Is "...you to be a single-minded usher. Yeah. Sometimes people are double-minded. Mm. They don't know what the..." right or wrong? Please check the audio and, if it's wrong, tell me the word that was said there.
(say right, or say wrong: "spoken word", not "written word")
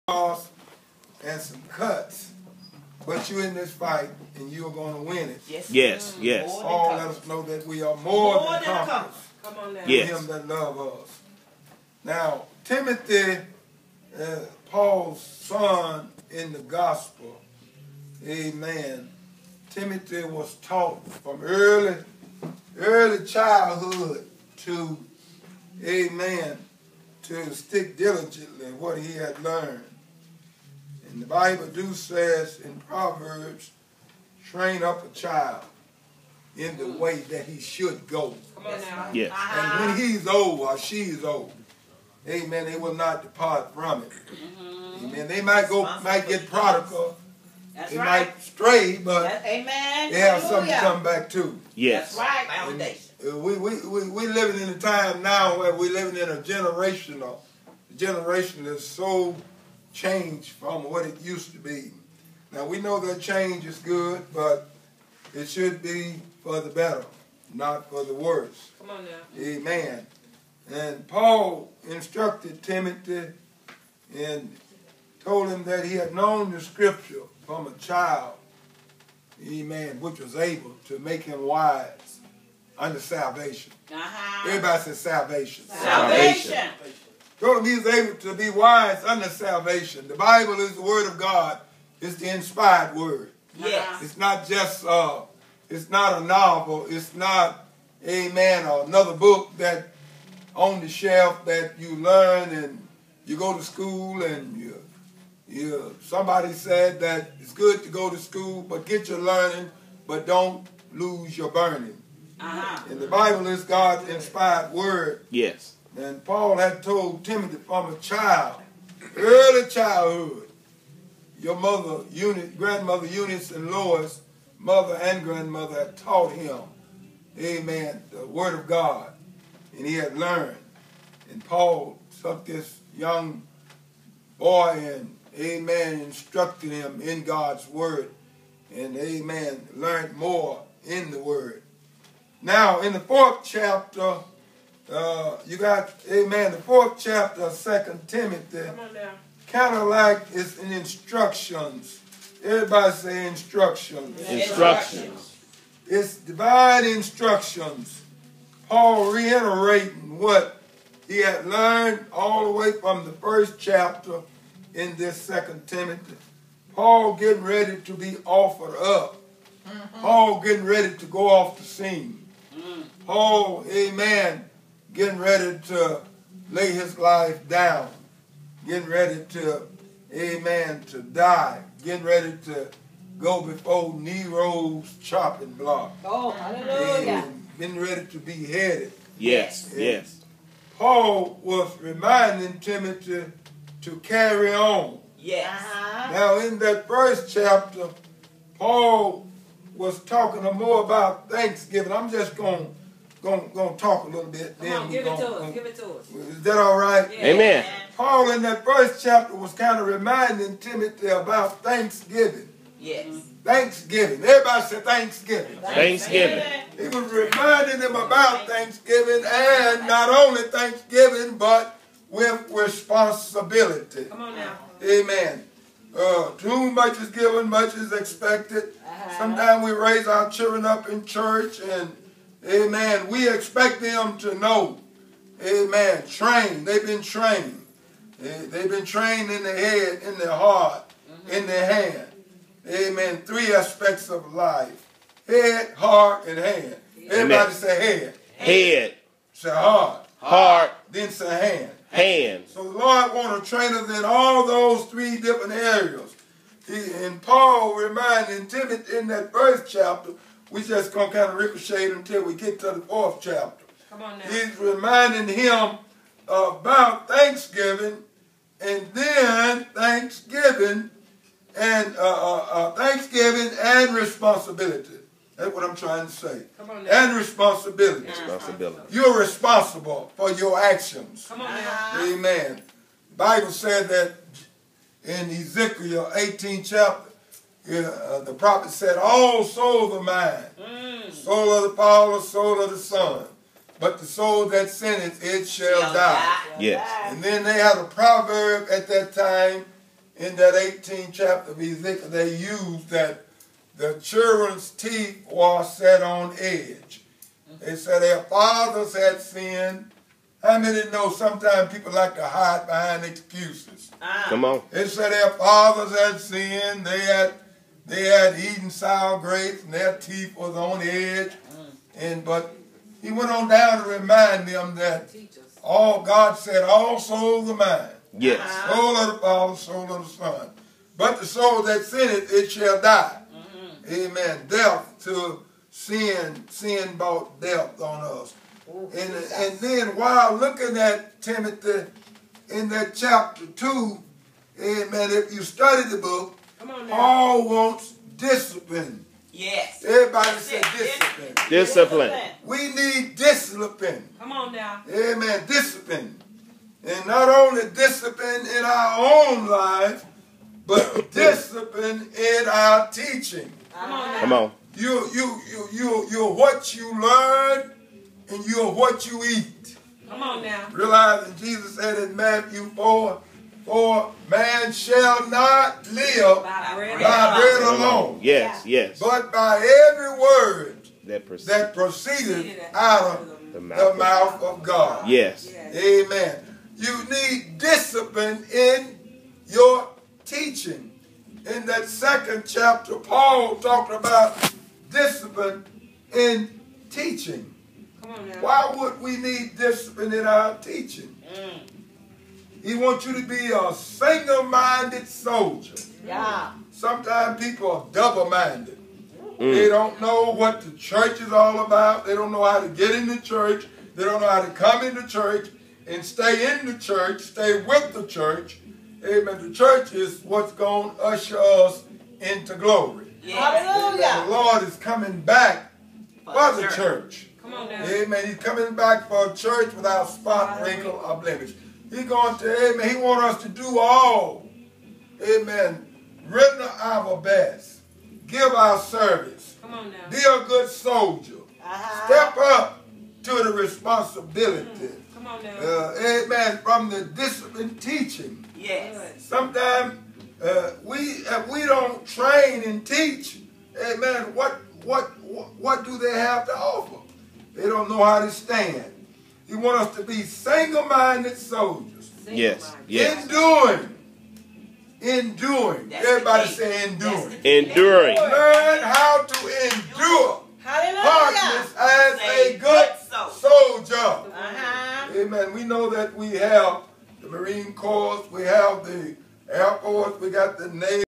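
wrong: "soldier", not "usher".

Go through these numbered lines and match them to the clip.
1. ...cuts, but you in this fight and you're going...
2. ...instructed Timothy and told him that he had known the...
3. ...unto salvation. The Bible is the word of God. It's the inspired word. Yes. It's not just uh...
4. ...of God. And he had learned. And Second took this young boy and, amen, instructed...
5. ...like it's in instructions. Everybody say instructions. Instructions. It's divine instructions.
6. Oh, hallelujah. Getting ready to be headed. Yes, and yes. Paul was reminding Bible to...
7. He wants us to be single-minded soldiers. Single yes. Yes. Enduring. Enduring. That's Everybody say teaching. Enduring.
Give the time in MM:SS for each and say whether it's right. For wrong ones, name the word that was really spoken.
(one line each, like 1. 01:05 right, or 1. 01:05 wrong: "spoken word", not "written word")
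1. 00:01 right
2. 01:11 right
3. 01:29 right
4. 02:08 wrong: "Paul", not "Second"
5. 02:29 right
6. 03:06 wrong: "Timothy", not "Bible"
7. 07:39 wrong: "enduring", not "teaching".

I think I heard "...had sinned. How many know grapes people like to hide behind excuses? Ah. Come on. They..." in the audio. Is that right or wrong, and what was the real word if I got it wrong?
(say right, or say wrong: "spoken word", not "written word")
wrong: "sometimes", not "grapes".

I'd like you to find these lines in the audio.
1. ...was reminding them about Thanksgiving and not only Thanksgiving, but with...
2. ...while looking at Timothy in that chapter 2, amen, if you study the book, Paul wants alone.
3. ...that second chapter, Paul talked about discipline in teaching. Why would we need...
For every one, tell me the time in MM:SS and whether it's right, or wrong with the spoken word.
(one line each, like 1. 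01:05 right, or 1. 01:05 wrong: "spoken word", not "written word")
1. 03:36 right
2. 05:39 wrong: "discipline", not "alone"
3. 06:31 right.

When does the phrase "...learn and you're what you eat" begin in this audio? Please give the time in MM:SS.
06:06.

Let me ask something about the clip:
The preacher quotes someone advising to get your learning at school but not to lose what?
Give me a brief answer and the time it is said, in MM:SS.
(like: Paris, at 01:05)
your burning, at 01:50.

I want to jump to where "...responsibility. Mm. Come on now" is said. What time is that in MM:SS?
07:23.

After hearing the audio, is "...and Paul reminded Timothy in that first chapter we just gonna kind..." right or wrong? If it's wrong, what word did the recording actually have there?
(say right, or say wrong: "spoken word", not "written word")
right.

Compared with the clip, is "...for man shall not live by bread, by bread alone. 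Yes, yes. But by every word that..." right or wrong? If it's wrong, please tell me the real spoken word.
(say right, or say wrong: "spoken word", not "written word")
right.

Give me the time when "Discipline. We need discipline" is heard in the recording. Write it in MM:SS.
05:51.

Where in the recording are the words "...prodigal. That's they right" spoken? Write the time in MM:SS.
00:46.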